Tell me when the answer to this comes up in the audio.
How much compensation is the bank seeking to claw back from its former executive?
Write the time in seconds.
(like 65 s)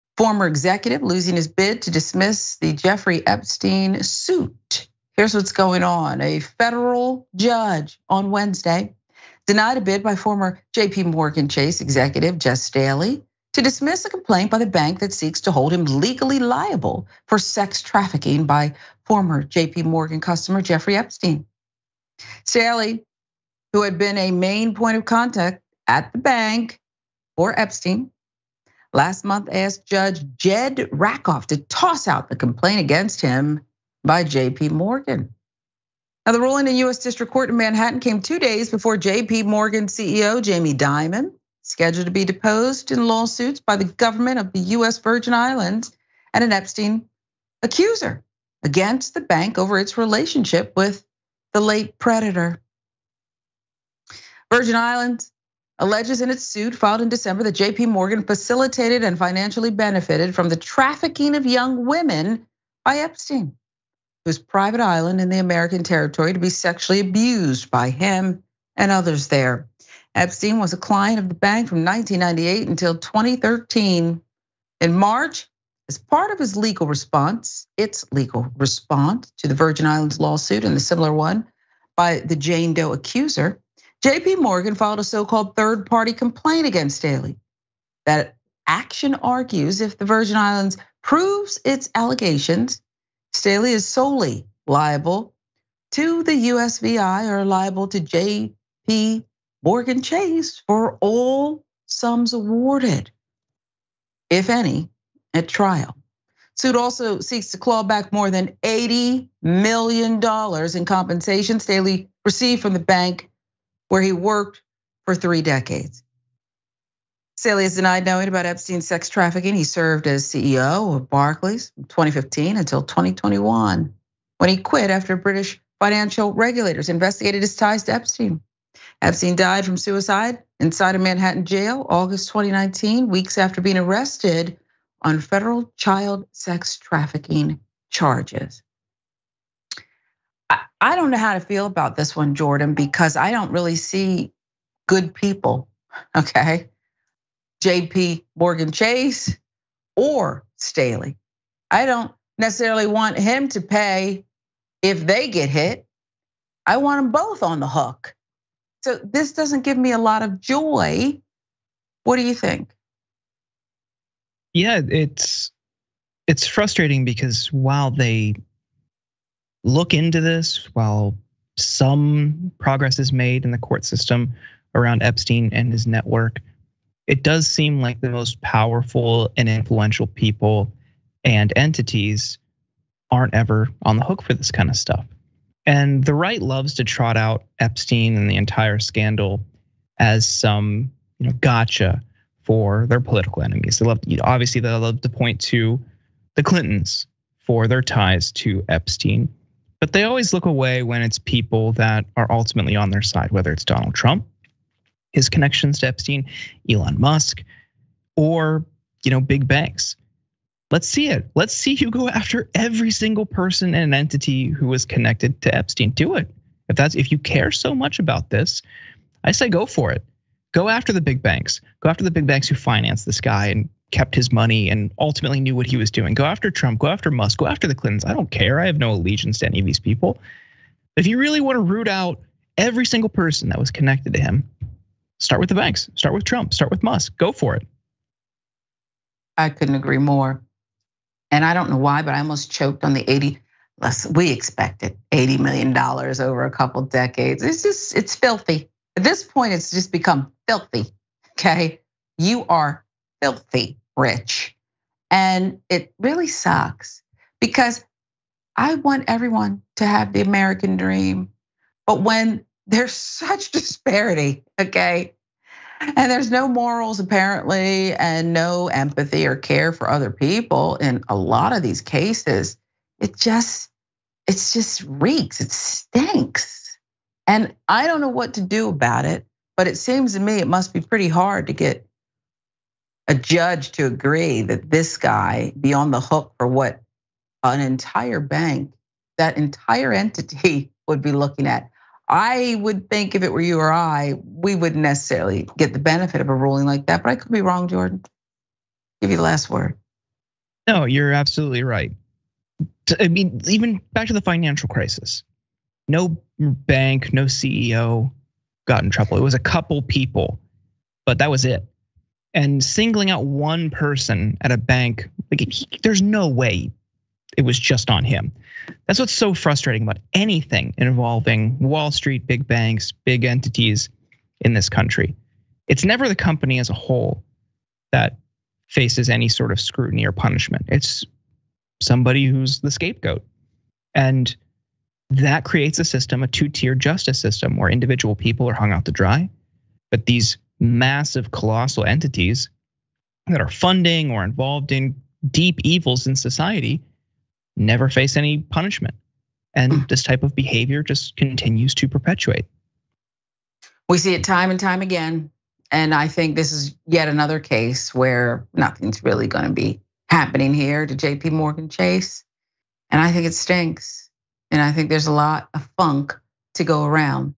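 108 s.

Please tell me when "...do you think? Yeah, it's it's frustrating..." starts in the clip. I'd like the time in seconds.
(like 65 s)
162 s.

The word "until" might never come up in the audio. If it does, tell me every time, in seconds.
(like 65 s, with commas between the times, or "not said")
72 s, 122 s.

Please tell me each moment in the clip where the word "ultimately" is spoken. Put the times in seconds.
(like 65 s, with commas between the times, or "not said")
202 s, 224 s.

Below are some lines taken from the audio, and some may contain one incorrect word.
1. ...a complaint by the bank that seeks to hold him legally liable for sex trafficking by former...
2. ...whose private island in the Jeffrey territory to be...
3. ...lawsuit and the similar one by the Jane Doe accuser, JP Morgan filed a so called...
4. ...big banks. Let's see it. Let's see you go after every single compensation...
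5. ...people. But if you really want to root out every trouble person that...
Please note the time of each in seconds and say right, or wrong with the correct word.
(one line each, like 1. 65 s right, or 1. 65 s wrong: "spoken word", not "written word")
1. 14 s right
2. 64 s wrong: "American", not "Jeffrey"
3. 80 s right
4. 209 s wrong: "person", not "compensation"
5. 229 s wrong: "single", not "trouble".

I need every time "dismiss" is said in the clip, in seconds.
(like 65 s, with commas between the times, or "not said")
1 s, 13 s.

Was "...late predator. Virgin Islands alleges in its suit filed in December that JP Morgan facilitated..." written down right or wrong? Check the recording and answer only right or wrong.
right.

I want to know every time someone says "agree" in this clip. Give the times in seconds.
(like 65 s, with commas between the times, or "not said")
239 s, 283 s.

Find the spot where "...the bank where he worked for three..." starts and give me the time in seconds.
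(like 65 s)
112 s.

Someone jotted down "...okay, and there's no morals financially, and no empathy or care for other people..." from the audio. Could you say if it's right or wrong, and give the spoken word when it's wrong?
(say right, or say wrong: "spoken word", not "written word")
wrong: "apparently", not "financially".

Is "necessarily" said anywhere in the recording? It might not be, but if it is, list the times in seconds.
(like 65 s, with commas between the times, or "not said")
152 s, 294 s.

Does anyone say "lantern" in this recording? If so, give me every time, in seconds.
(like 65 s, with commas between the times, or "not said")
not said.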